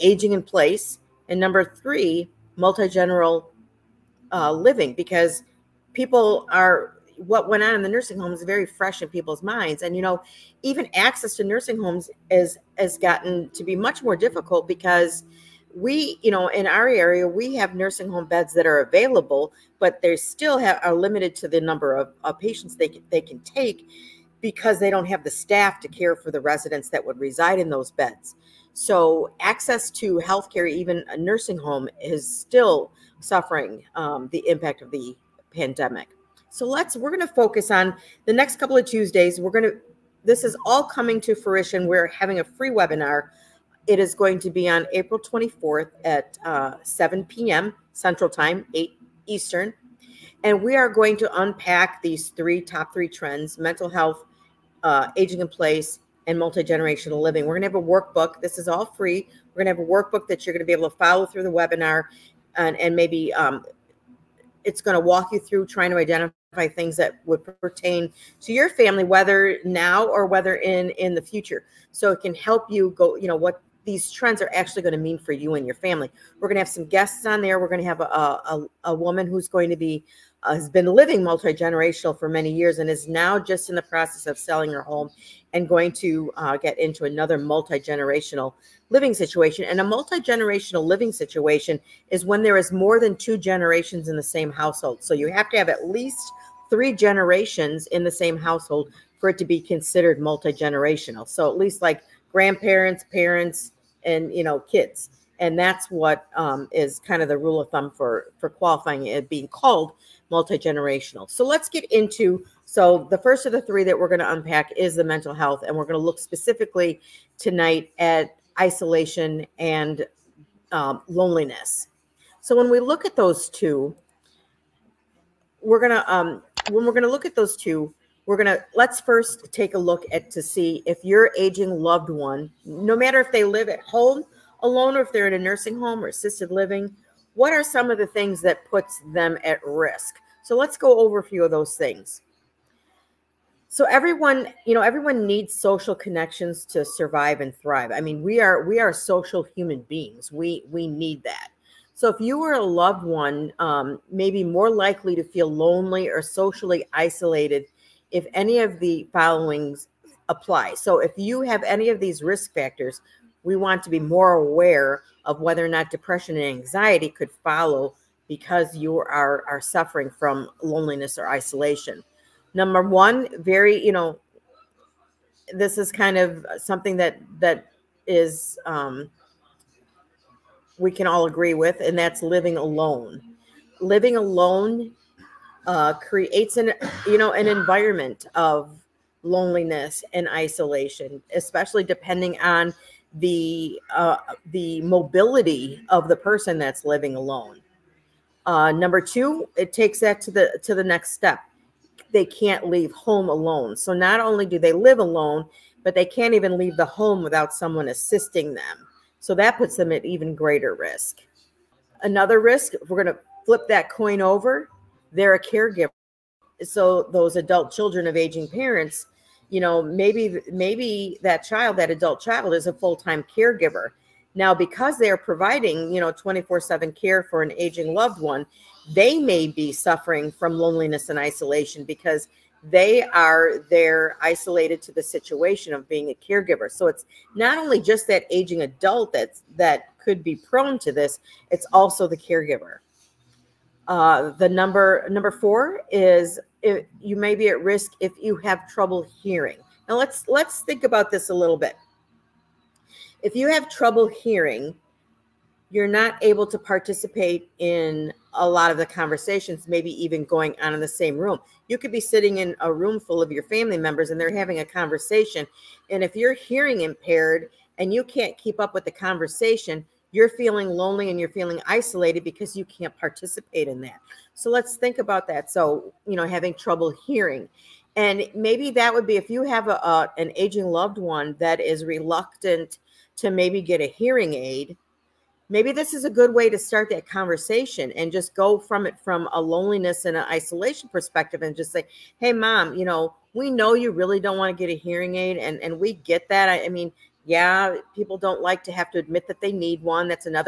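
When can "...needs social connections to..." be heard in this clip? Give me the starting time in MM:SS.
02:25.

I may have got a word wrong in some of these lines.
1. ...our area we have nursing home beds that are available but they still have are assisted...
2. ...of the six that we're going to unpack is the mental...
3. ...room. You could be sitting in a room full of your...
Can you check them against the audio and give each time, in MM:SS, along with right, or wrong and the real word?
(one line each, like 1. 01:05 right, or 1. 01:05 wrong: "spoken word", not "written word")
1. 00:16 wrong: "limited", not "assisted"
2. 01:53 wrong: "three", not "six"
3. 04:21 right.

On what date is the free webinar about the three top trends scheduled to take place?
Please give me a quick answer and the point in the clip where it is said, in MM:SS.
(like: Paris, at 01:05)
April 24th, at 00:44.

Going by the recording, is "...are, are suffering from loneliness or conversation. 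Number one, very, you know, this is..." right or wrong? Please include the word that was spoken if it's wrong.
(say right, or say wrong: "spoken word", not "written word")
wrong: "isolation", not "conversation".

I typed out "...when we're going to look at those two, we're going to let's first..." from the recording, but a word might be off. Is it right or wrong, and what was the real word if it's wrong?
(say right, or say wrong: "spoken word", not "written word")
right.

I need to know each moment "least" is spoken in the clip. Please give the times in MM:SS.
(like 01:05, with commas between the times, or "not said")
01:35, 01:41.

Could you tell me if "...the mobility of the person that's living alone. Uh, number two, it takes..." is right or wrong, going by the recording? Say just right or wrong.
right.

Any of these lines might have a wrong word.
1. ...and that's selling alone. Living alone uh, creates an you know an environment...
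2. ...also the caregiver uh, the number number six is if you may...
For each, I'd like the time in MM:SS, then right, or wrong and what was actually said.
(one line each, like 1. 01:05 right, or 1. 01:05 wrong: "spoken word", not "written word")
1. 03:01 wrong: "living", not "selling"
2. 04:01 wrong: "four", not "six".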